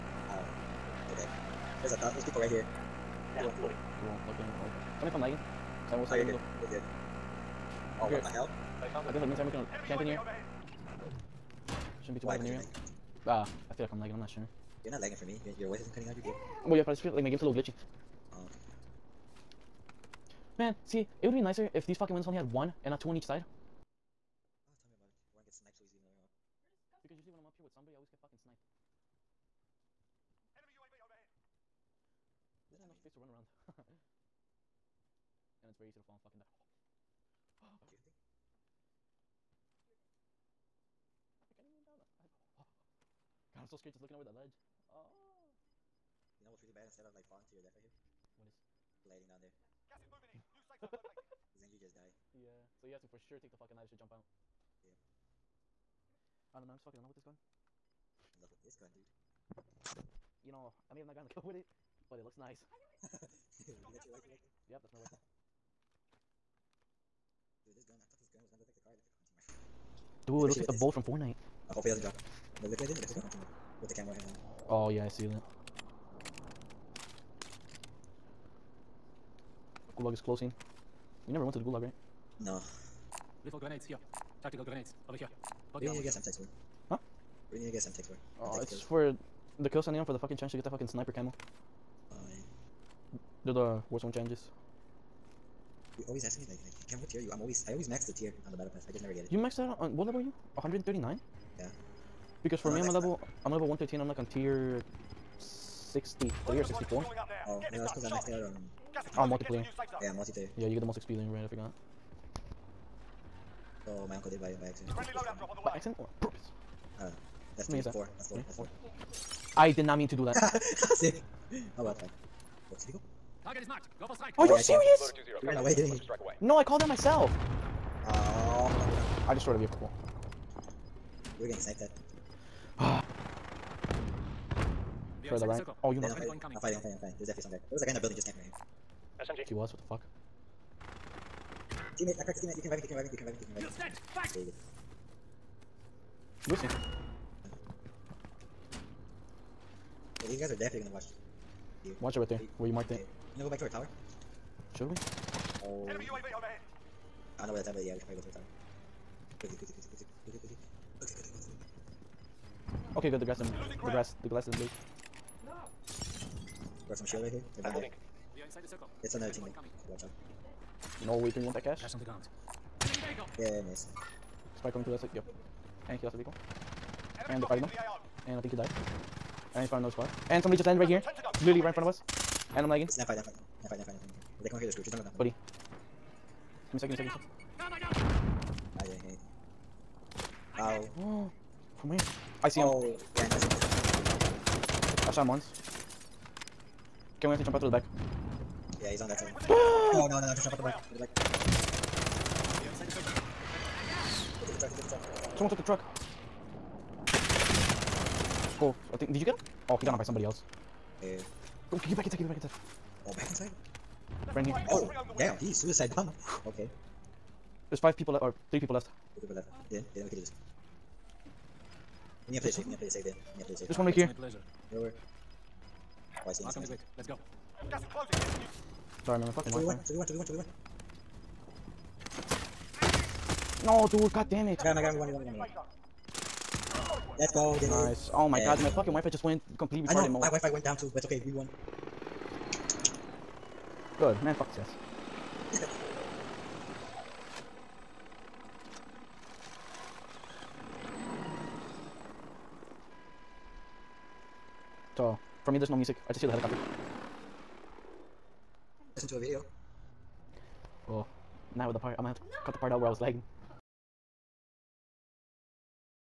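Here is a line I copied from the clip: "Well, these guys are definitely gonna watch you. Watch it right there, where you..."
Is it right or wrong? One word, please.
right.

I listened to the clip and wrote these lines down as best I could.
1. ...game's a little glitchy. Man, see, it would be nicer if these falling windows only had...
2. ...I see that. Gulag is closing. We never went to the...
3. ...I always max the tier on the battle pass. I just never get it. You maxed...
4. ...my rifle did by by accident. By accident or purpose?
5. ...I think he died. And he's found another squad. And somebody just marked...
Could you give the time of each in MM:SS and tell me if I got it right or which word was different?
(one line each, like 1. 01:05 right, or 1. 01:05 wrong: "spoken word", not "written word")
1. 00:17 wrong: "fucking", not "falling"
2. 01:15 right
3. 01:37 right
4. 01:54 wrong: "uncle", not "rifle"
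5. 02:58 wrong: "landed", not "marked".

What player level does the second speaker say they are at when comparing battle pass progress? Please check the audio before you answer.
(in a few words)
113.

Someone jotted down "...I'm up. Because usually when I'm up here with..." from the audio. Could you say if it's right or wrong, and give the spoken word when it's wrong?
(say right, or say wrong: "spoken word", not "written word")
right.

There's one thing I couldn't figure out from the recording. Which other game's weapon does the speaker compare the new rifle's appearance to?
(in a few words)
Fortnite.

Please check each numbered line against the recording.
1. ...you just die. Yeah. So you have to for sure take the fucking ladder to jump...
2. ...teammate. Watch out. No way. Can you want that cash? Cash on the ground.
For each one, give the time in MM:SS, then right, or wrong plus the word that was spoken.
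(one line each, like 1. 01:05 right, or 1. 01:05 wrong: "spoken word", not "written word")
1. 00:51 right
2. 02:49 right.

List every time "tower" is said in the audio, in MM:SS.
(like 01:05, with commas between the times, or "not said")
02:33, 02:38.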